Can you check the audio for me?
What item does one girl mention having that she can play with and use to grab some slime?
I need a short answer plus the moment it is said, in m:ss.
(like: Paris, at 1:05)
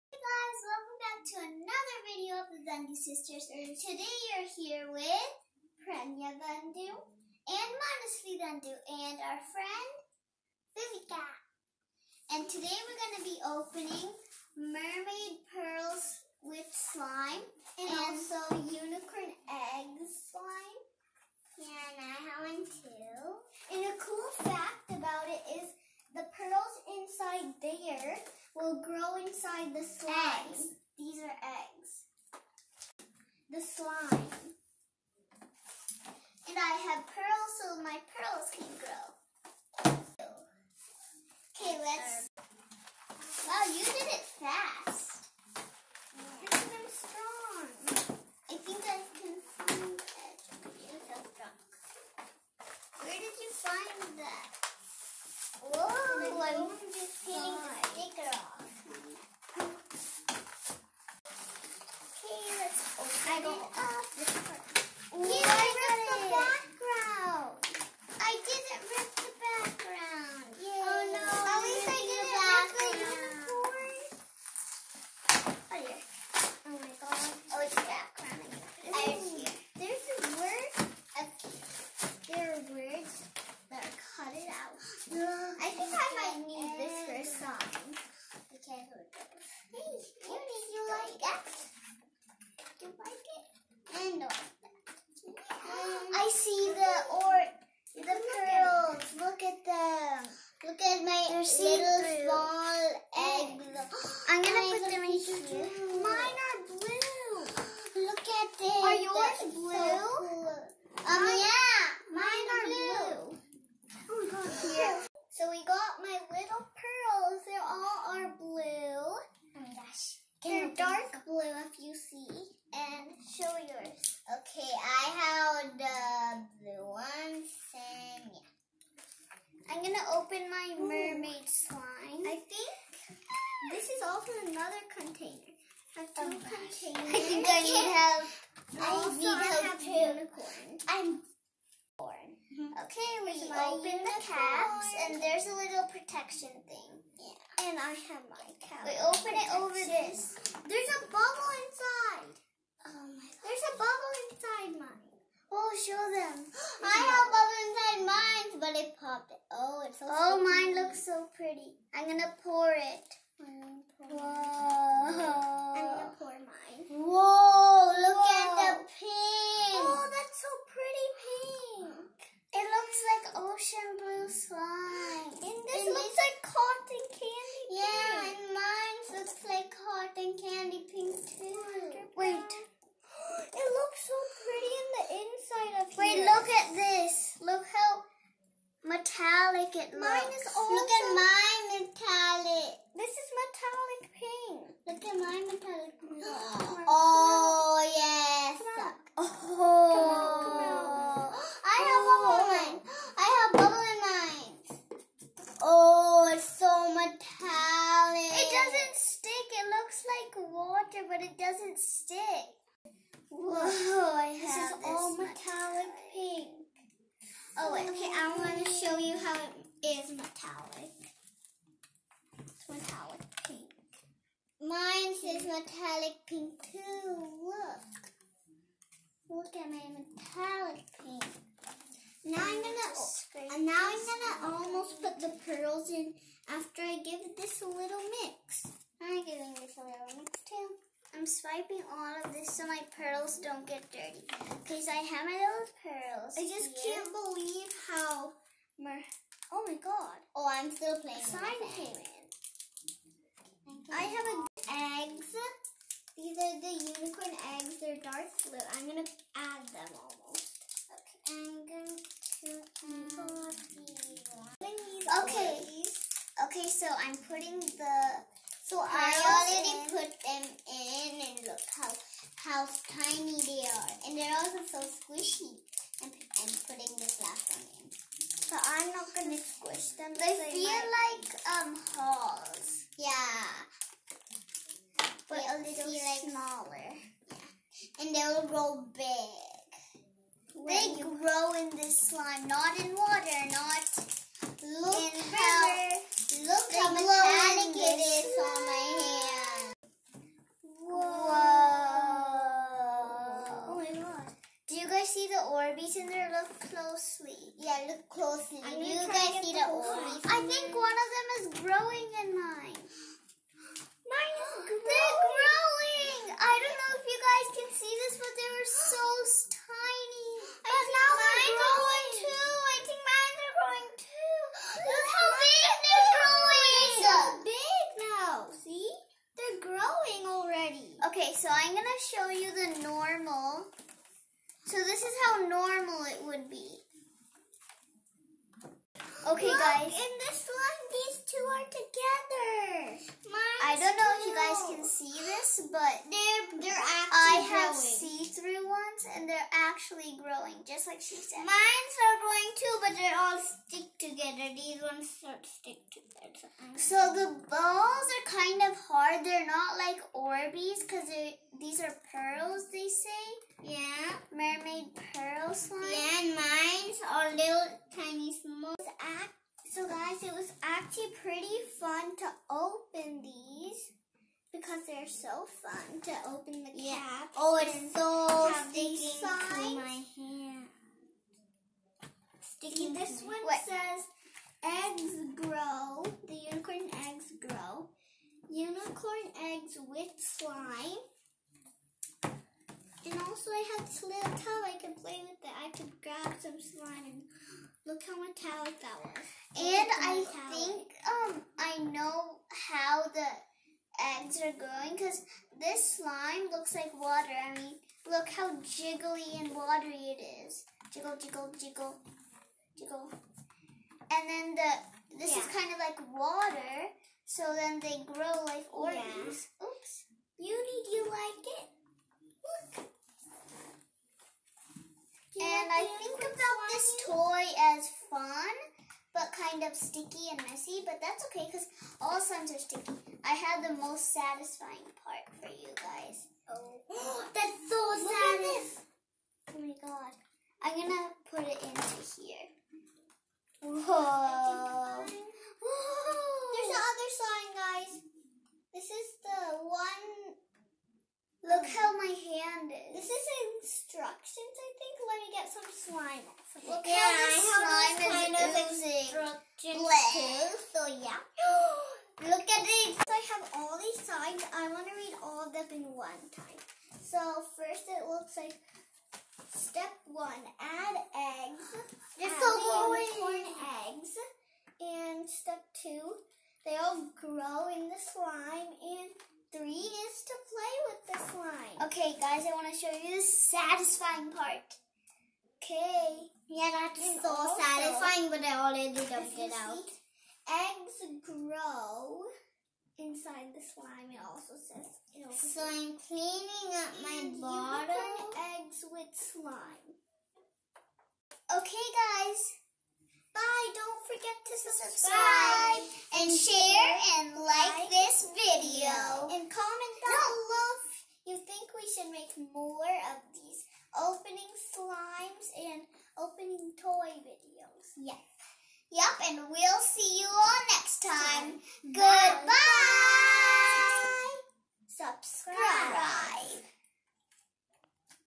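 little towel, at 6:34.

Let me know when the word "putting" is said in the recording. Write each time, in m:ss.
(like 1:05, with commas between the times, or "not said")
4:27, 4:36.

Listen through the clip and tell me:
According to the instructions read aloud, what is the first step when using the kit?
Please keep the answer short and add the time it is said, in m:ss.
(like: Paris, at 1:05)
add eggs, at 7:50.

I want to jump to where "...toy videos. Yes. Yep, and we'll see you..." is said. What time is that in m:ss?
8:36.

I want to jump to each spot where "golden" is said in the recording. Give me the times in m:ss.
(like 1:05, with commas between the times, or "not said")
not said.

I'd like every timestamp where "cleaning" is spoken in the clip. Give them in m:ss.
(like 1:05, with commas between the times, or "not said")
8:15.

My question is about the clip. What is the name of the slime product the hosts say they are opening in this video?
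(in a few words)
Mermaid Pearls.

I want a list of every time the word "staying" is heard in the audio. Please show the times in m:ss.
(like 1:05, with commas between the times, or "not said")
not said.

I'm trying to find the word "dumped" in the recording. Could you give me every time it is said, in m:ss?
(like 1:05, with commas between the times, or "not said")
8:08.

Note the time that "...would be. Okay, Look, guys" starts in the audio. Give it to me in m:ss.
5:36.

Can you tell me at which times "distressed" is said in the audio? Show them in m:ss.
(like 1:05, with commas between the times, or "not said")
not said.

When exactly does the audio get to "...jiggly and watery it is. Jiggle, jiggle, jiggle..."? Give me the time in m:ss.
6:48.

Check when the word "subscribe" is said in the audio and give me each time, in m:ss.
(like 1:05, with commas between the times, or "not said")
8:24, 8:44.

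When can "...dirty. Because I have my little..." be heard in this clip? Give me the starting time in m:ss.
4:03.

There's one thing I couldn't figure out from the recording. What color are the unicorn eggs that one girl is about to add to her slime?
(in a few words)
dark blue.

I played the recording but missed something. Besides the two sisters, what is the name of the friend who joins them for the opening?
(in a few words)
Vivica.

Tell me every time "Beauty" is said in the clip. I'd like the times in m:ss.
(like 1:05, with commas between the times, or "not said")
7:00.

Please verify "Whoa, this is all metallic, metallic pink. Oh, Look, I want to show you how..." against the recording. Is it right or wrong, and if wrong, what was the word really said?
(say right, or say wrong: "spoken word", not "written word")
wrong: "Okay", not "Look".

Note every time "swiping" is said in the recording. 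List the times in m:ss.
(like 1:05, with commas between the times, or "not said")
4:01.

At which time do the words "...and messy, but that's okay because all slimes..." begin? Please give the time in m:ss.
7:10.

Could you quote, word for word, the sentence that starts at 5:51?
Mine's are growing too, but they all stick together.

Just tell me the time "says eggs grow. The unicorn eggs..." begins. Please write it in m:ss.
6:23.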